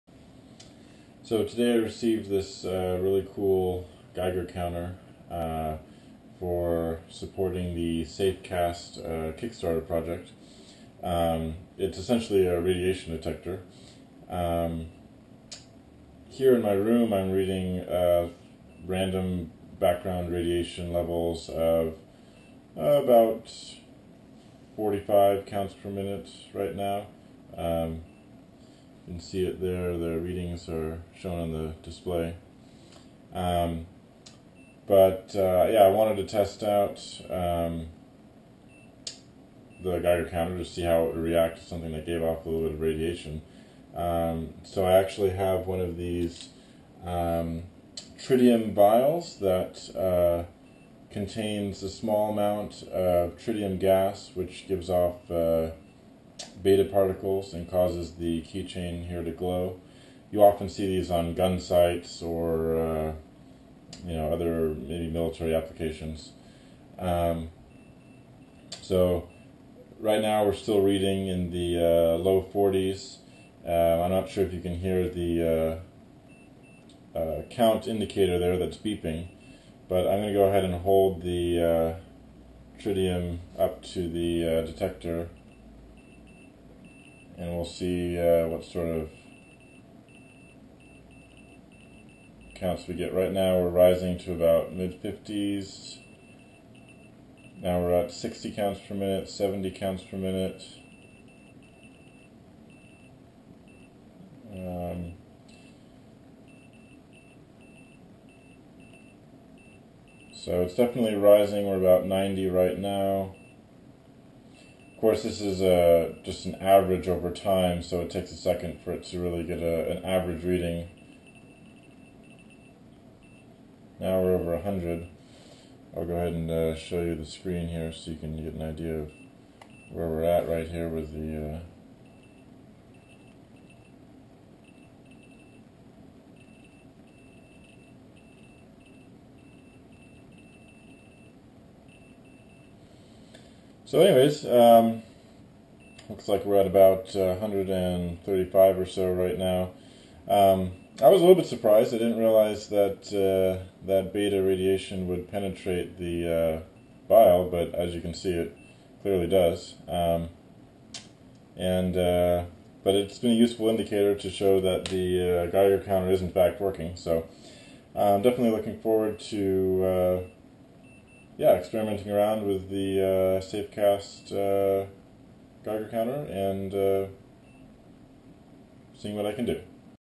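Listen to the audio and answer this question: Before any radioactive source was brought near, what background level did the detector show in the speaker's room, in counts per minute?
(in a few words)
45.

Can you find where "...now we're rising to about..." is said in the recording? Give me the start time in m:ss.
1:33.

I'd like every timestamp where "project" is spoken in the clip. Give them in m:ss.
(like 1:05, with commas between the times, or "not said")
0:09.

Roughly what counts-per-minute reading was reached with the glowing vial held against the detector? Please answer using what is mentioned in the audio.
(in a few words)
135.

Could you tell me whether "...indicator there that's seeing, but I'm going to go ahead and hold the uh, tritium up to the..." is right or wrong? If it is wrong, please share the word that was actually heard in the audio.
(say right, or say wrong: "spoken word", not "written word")
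wrong: "beeping", not "seeing".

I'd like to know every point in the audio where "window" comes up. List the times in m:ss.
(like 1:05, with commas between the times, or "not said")
not said.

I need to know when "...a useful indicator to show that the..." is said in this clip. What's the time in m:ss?
2:43.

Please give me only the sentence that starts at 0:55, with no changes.
Uh, beta particles and causes the keychain here to glow.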